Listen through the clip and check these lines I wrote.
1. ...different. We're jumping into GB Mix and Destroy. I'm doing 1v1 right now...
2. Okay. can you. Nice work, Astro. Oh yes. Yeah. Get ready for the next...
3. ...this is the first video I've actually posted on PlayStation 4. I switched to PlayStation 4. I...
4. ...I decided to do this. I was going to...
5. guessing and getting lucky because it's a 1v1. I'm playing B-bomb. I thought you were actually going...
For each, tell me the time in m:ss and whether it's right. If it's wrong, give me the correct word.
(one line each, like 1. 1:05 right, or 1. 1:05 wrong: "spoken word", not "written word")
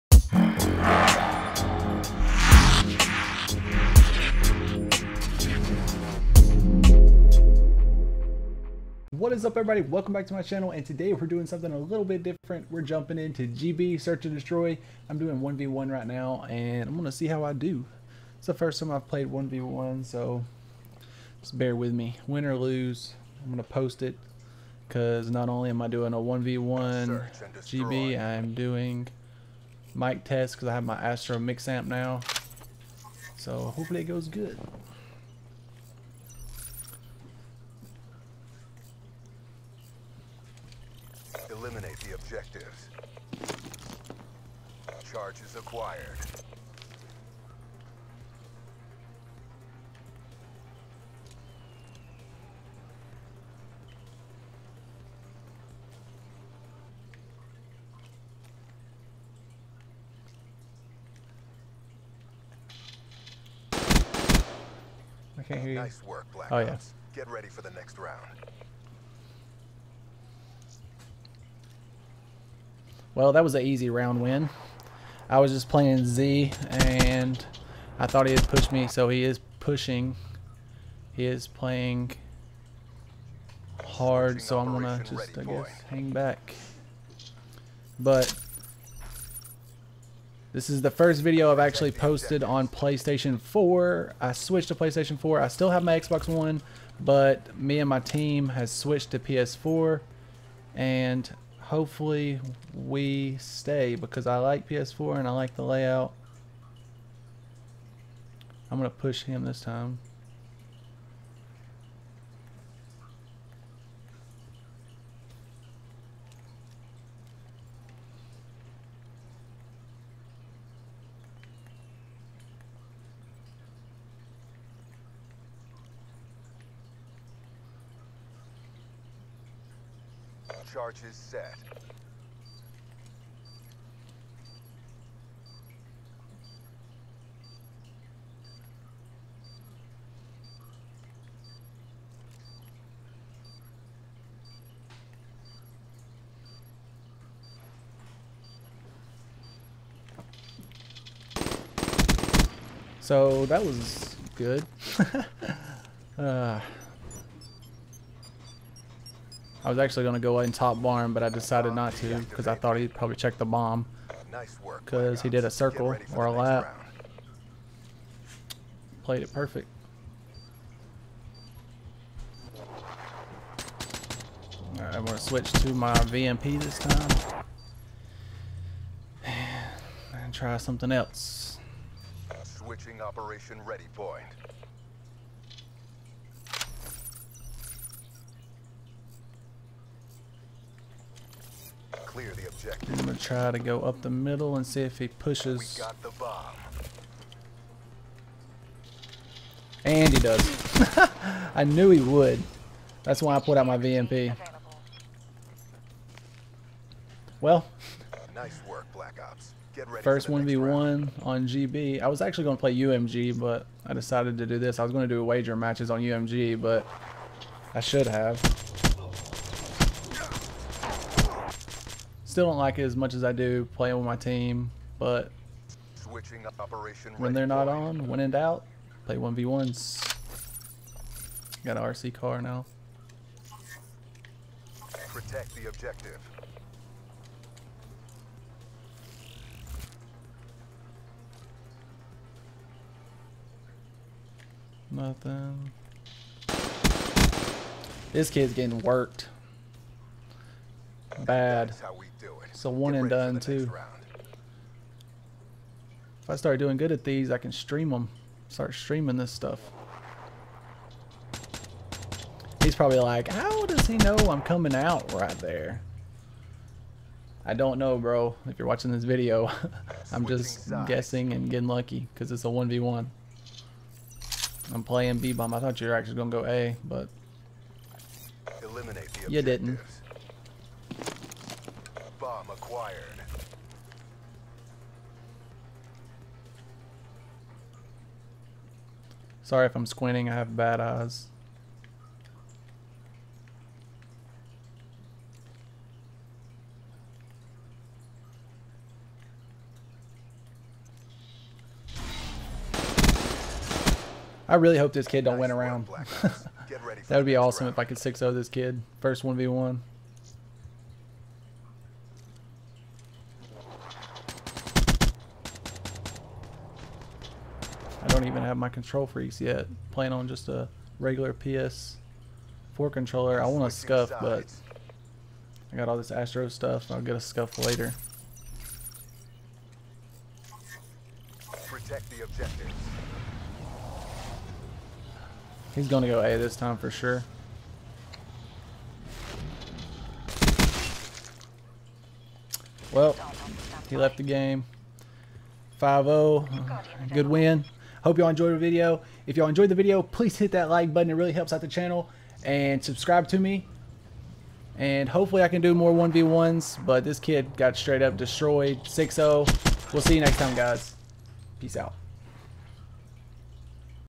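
1. 0:12 wrong: "Search", not "Mix"
2. 1:05 wrong: "Black", not "Astro"
3. 1:30 right
4. 3:33 right
5. 4:30 right.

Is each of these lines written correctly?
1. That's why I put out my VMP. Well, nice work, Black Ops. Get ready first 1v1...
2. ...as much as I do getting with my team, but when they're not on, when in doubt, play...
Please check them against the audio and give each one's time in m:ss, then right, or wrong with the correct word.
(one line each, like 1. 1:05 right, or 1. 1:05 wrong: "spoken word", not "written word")
1. 3:23 right
2. 3:42 wrong: "playing", not "getting".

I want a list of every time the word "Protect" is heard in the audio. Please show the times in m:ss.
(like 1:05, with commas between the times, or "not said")
3:55, 5:31.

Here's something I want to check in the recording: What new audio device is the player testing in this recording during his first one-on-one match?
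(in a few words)
Astro Mix Amp.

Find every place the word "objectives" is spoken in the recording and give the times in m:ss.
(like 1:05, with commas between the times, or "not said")
0:42, 3:12, 3:55, 5:32.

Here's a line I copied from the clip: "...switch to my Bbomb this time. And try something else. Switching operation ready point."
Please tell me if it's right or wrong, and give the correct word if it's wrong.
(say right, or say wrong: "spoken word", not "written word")
wrong: "VMP", not "Bbomb".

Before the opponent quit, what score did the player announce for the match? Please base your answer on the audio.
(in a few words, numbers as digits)
5-0.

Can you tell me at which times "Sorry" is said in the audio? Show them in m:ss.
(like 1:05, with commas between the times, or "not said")
4:49.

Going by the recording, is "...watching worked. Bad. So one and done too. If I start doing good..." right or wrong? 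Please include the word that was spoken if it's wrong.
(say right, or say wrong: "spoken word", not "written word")
wrong: "getting", not "watching".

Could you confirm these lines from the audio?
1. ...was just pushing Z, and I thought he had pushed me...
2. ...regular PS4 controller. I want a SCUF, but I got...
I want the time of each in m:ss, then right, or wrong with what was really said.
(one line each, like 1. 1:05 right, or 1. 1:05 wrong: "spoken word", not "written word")
1. 1:15 wrong: "playing", not "pushing"
2. 5:20 right.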